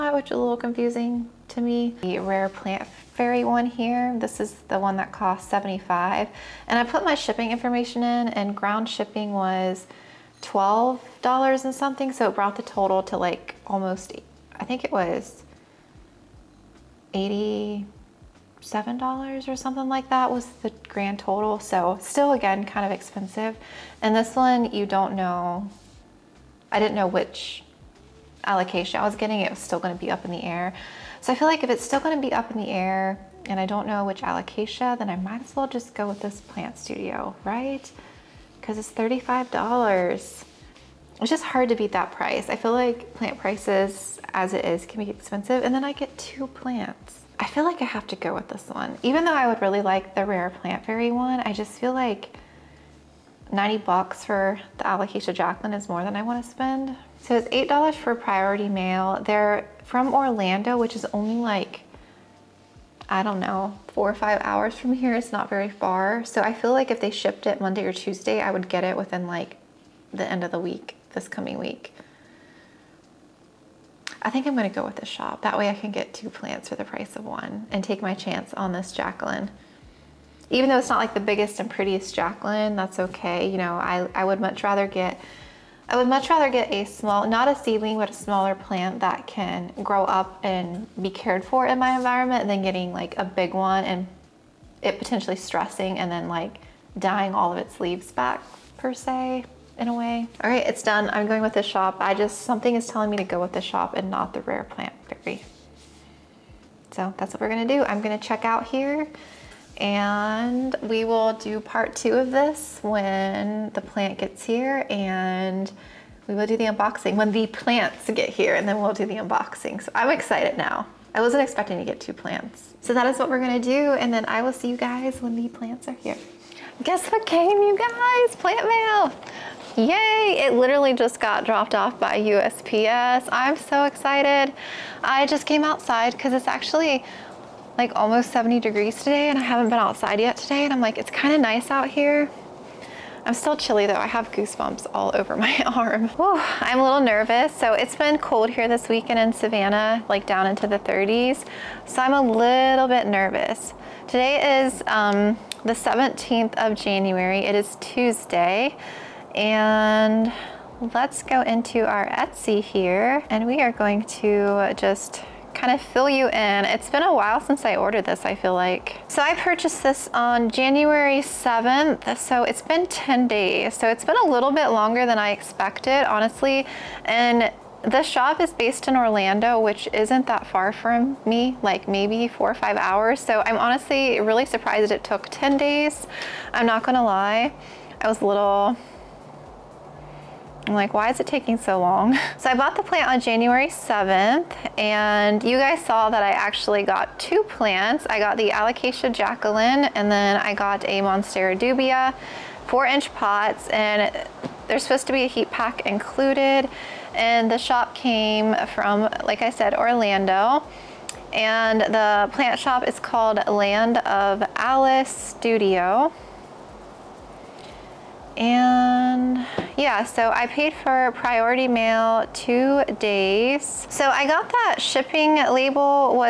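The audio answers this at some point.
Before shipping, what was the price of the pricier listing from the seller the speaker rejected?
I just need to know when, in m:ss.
0:05.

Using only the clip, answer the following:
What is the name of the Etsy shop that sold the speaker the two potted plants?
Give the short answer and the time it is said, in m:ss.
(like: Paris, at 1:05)
Land of Alice Studio, at 3:33.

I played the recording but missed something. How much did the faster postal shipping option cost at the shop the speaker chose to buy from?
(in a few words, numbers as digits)
$8.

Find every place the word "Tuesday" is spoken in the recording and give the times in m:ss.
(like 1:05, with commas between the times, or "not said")
1:07, 2:37.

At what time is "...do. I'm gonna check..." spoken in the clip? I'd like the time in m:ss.
1:47.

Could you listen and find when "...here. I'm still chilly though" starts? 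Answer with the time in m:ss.
2:21.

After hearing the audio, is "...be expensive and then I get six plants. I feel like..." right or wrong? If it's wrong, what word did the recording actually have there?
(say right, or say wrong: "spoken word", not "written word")
wrong: "two", not "six".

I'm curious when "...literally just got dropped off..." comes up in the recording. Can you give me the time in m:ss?
2:10.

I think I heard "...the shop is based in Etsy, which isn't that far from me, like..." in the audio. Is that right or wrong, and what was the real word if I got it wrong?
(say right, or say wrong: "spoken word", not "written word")
wrong: "Orlando", not "Etsy".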